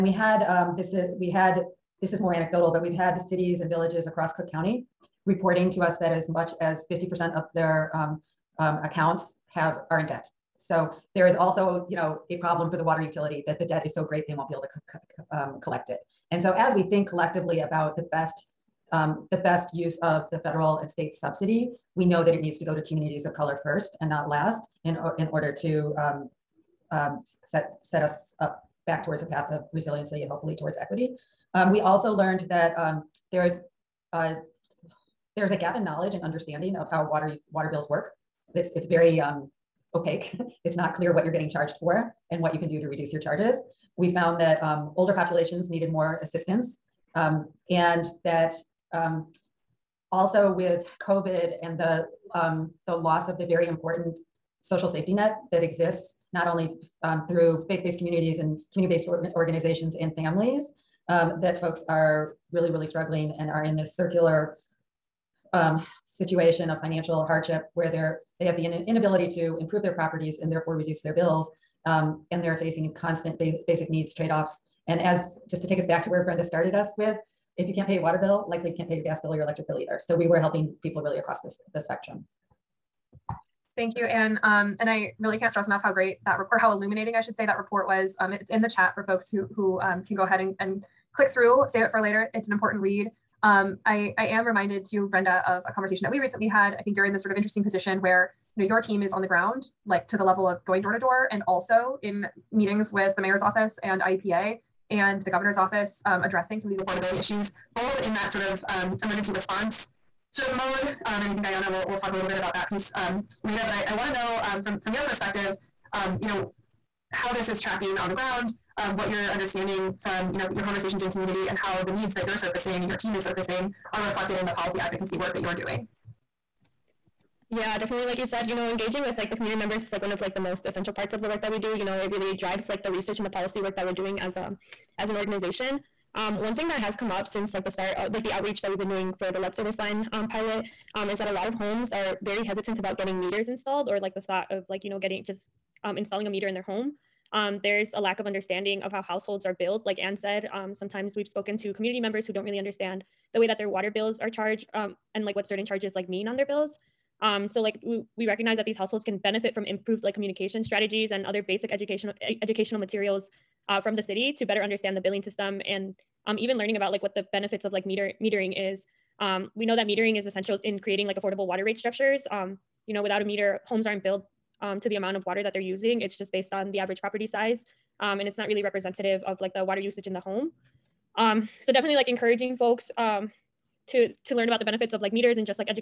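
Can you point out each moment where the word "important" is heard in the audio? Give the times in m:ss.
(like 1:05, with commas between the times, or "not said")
0:53, 1:32.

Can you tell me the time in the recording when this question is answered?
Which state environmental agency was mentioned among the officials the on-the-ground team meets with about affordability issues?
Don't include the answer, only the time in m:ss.
1:44.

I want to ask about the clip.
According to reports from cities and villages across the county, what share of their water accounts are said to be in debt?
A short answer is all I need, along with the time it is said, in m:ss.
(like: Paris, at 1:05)
50%, at 0:06.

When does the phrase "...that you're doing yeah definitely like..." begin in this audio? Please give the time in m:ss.
2:05.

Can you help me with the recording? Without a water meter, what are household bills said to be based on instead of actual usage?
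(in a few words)
average property size.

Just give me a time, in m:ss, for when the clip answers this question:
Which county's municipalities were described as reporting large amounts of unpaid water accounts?
0:04.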